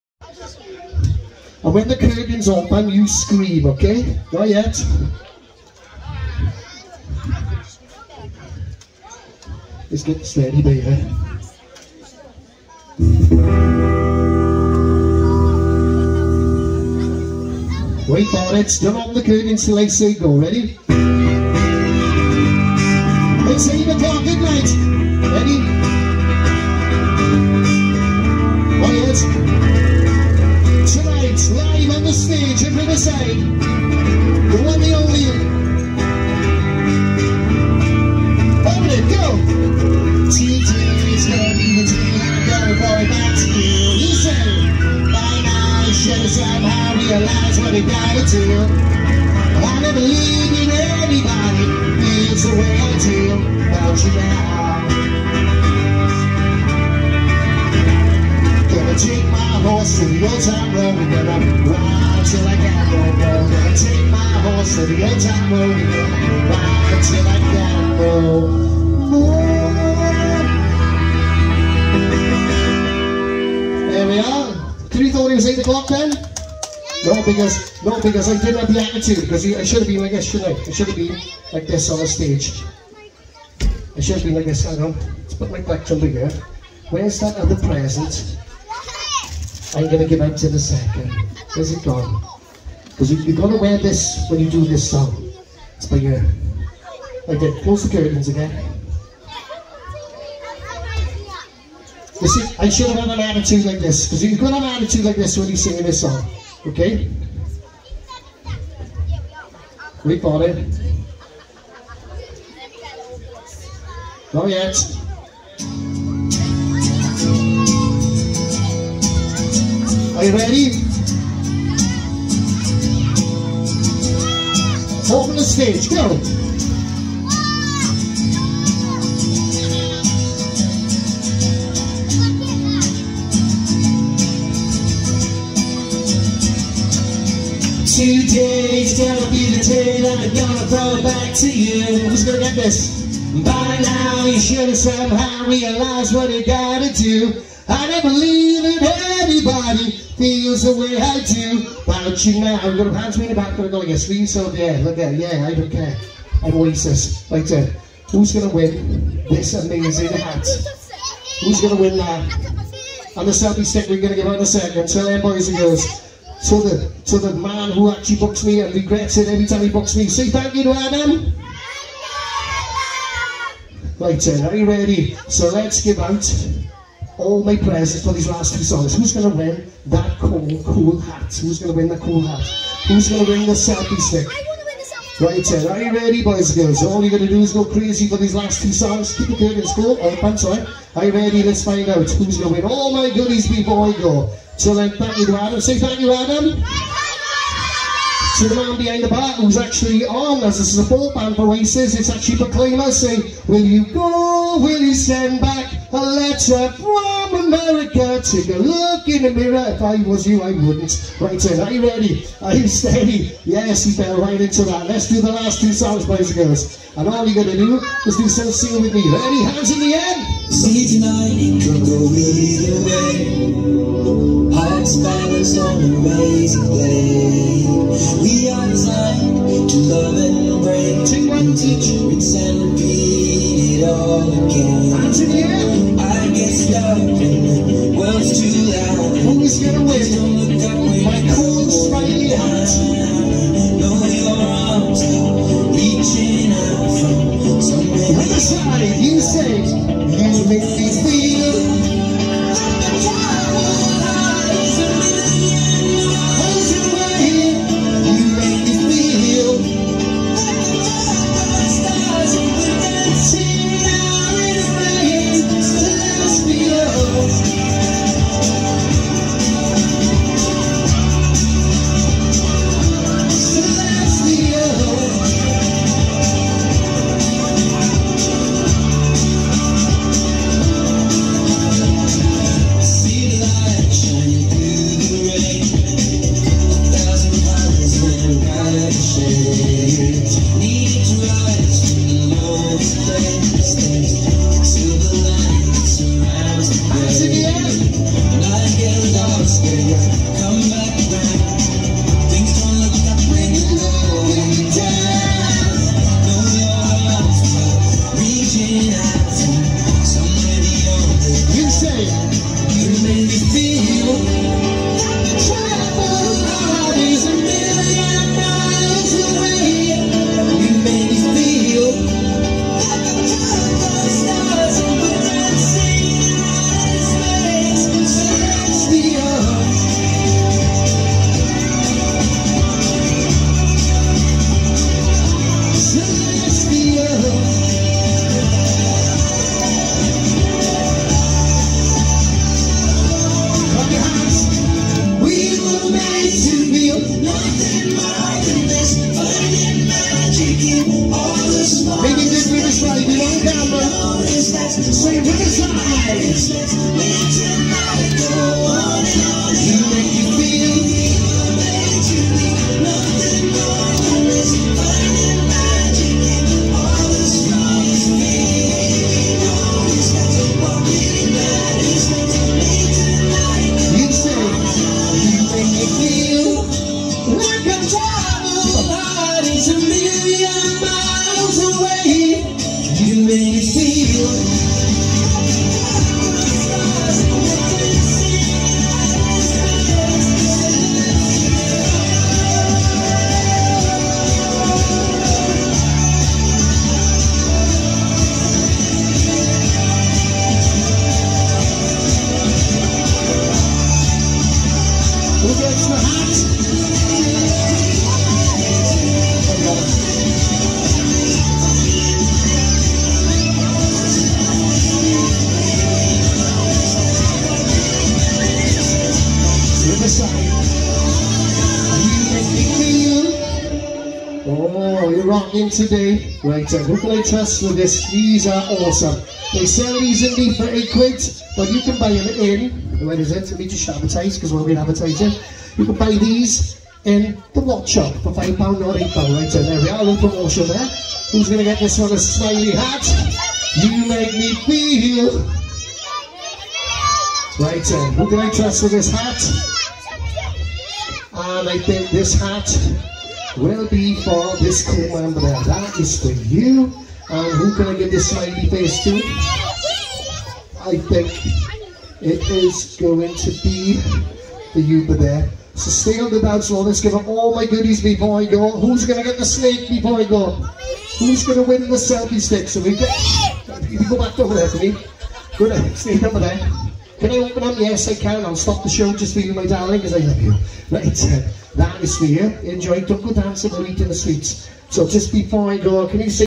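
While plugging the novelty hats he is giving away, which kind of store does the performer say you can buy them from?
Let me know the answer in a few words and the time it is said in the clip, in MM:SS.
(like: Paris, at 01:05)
the watch shop, at 07:17.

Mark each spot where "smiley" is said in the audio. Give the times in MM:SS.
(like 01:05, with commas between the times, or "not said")
07:22, 07:38.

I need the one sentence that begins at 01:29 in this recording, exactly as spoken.
I'm going to give out in a second.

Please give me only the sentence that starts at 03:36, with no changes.
And all you're going to do is do some singing with me.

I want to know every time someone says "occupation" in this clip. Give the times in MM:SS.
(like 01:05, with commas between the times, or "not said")
not said.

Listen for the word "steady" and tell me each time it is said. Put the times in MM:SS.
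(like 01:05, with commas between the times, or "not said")
00:10, 03:32.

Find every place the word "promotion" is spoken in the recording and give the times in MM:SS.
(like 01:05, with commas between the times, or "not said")
07:20.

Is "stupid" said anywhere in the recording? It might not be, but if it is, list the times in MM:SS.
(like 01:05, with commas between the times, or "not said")
not said.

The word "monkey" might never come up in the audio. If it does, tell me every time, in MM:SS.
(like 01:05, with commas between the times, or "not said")
not said.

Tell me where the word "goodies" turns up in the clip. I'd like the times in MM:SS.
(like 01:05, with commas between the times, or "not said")
03:13, 07:47.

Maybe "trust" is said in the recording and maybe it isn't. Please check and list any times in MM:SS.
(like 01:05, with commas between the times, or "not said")
07:07, 07:28.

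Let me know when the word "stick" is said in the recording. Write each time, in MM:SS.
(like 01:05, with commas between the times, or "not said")
02:43, 03:03, 07:52.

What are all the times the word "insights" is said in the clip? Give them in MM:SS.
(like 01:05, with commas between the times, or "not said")
not said.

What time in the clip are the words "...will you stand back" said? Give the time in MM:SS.
03:24.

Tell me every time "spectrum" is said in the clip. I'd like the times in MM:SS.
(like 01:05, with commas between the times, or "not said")
not said.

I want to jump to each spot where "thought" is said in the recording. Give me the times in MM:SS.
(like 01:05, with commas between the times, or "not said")
01:15.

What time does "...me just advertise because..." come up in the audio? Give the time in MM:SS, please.
07:13.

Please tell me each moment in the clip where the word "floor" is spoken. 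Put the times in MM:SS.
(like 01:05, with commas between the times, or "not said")
07:46.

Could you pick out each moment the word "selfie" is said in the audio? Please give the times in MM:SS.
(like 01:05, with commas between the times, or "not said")
02:43, 03:03, 07:51.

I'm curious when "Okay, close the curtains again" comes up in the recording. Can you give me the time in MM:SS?
01:37.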